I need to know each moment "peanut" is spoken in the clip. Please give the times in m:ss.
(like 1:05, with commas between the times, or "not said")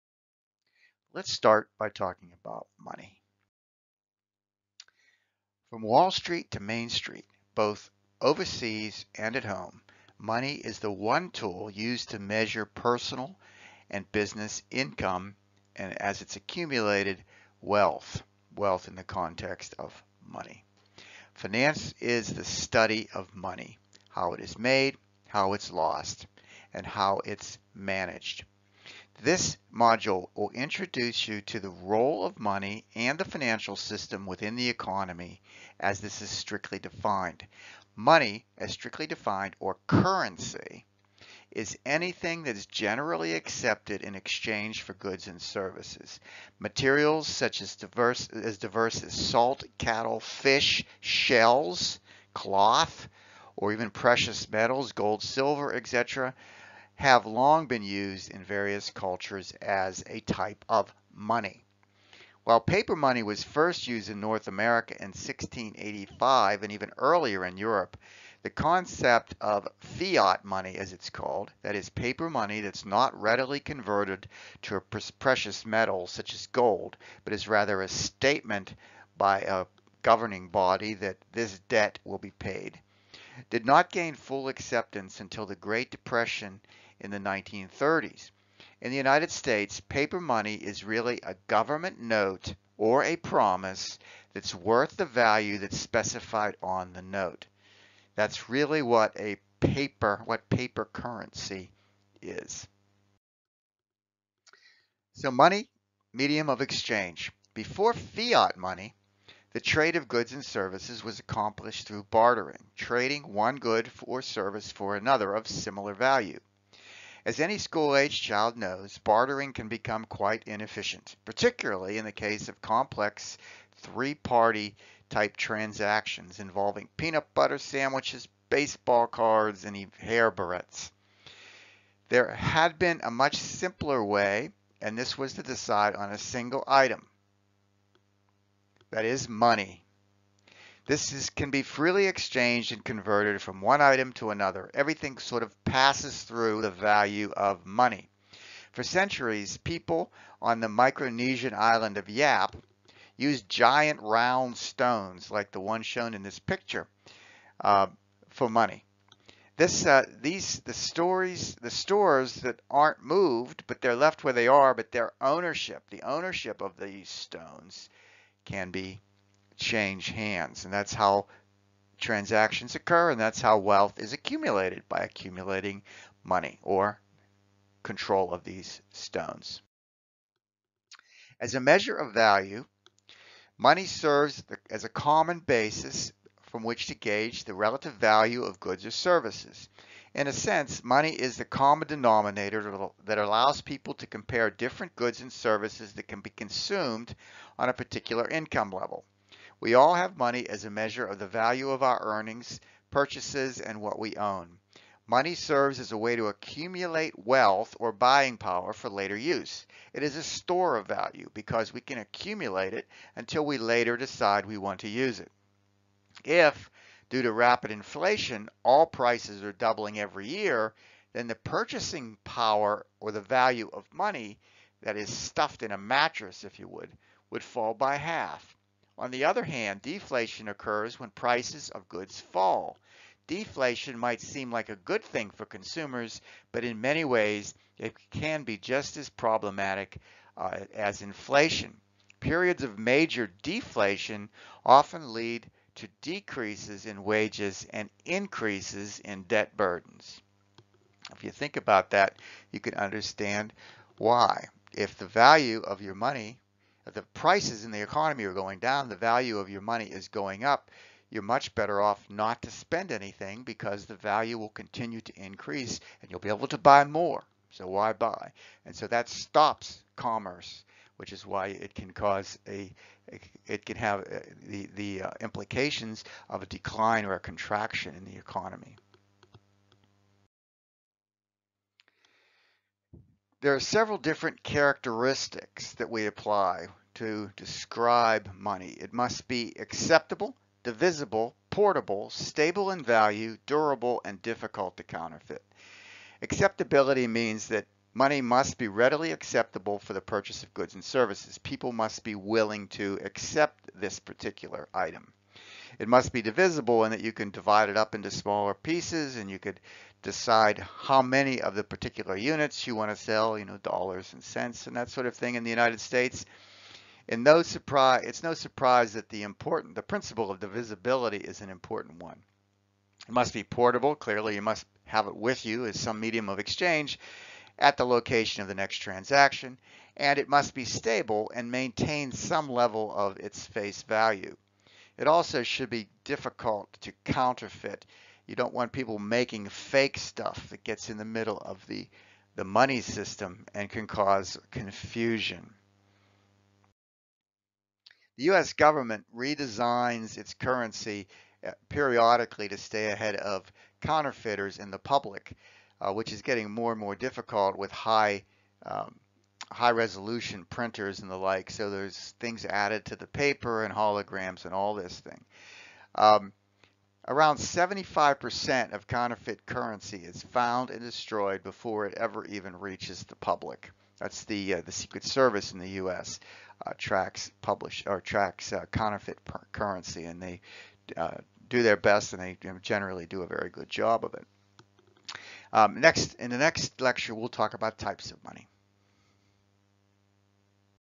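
2:06.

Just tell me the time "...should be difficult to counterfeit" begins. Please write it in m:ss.
5:35.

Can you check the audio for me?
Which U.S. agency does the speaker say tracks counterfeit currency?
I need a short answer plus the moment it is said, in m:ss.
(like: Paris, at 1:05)
The Secret Service, at 6:14.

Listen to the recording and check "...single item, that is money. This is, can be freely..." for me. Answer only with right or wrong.
right.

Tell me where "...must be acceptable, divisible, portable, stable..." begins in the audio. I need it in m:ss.
4:48.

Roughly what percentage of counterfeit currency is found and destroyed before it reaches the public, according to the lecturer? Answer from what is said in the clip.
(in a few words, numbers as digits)
75%.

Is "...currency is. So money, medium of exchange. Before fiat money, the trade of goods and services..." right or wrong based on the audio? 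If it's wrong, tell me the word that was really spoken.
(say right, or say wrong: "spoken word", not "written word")
right.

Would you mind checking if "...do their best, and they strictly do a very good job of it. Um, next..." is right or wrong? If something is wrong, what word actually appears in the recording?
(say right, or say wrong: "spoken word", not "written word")
wrong: "generally", not "strictly".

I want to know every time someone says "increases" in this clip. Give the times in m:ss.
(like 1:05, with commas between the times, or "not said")
4:08, 4:25.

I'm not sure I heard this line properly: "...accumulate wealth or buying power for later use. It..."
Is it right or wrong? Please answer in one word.
right.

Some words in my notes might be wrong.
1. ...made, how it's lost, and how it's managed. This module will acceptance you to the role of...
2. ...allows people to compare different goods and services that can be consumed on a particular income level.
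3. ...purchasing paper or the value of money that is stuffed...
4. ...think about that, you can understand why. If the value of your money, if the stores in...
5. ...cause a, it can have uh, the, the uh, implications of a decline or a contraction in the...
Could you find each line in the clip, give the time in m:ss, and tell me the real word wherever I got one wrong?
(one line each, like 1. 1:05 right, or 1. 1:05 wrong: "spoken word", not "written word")
1. 0:24 wrong: "introduce", not "acceptance"
2. 3:13 right
3. 3:41 wrong: "power", not "paper"
4. 4:11 wrong: "prices", not "stores"
5. 4:31 right.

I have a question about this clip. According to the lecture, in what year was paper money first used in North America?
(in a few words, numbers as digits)
1685.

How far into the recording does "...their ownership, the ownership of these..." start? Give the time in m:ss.
2:44.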